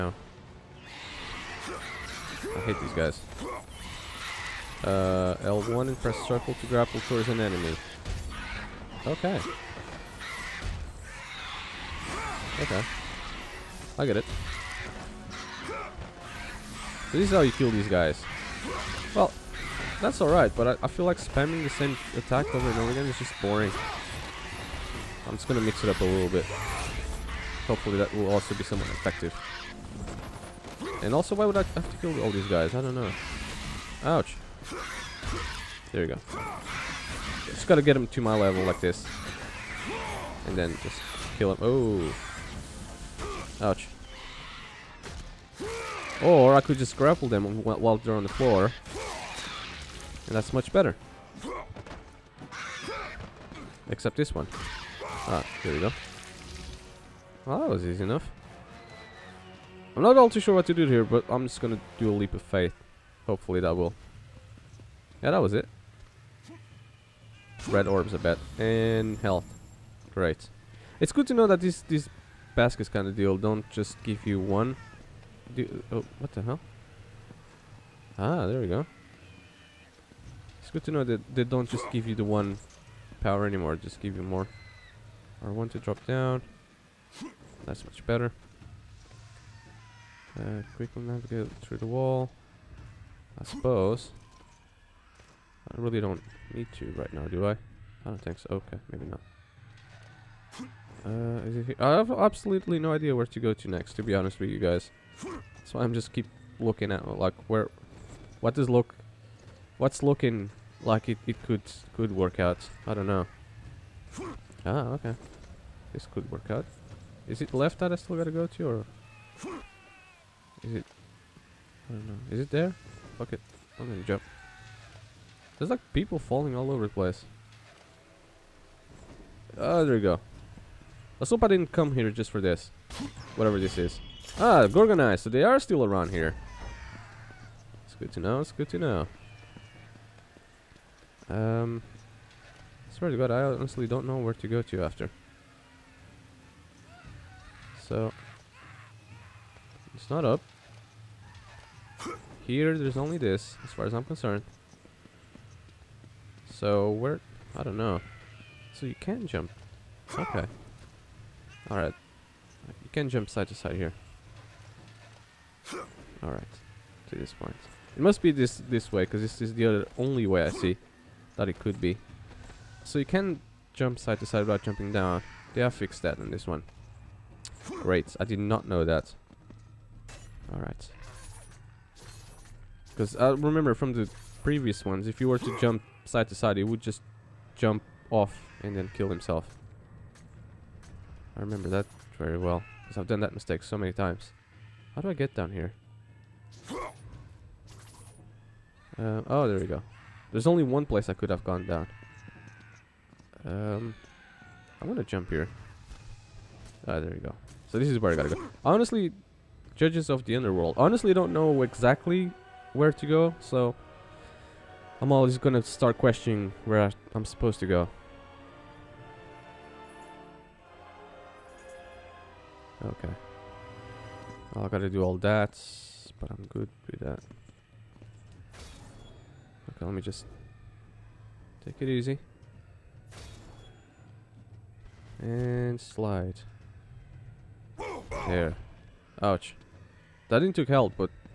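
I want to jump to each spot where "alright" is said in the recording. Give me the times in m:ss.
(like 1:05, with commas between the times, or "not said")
0:20, 2:41, 2:46, 3:00.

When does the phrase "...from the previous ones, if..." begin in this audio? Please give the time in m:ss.
3:03.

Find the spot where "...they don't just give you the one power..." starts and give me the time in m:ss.
1:21.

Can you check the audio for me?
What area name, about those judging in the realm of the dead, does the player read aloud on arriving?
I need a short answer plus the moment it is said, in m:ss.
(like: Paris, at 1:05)
Judges of the underworld, at 3:29.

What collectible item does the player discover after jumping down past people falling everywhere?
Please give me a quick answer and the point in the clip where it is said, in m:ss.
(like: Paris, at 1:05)
Gorgon Eyes, at 2:14.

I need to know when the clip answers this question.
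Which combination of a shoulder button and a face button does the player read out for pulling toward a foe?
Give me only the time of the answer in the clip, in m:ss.
0:05.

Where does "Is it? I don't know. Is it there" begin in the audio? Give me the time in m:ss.
2:00.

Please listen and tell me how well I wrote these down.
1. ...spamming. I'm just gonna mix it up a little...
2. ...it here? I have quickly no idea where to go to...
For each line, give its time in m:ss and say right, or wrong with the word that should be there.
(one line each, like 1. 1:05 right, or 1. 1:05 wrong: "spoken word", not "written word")
1. 0:23 wrong: "boring", not "spamming"
2. 1:41 wrong: "absolutely", not "quickly".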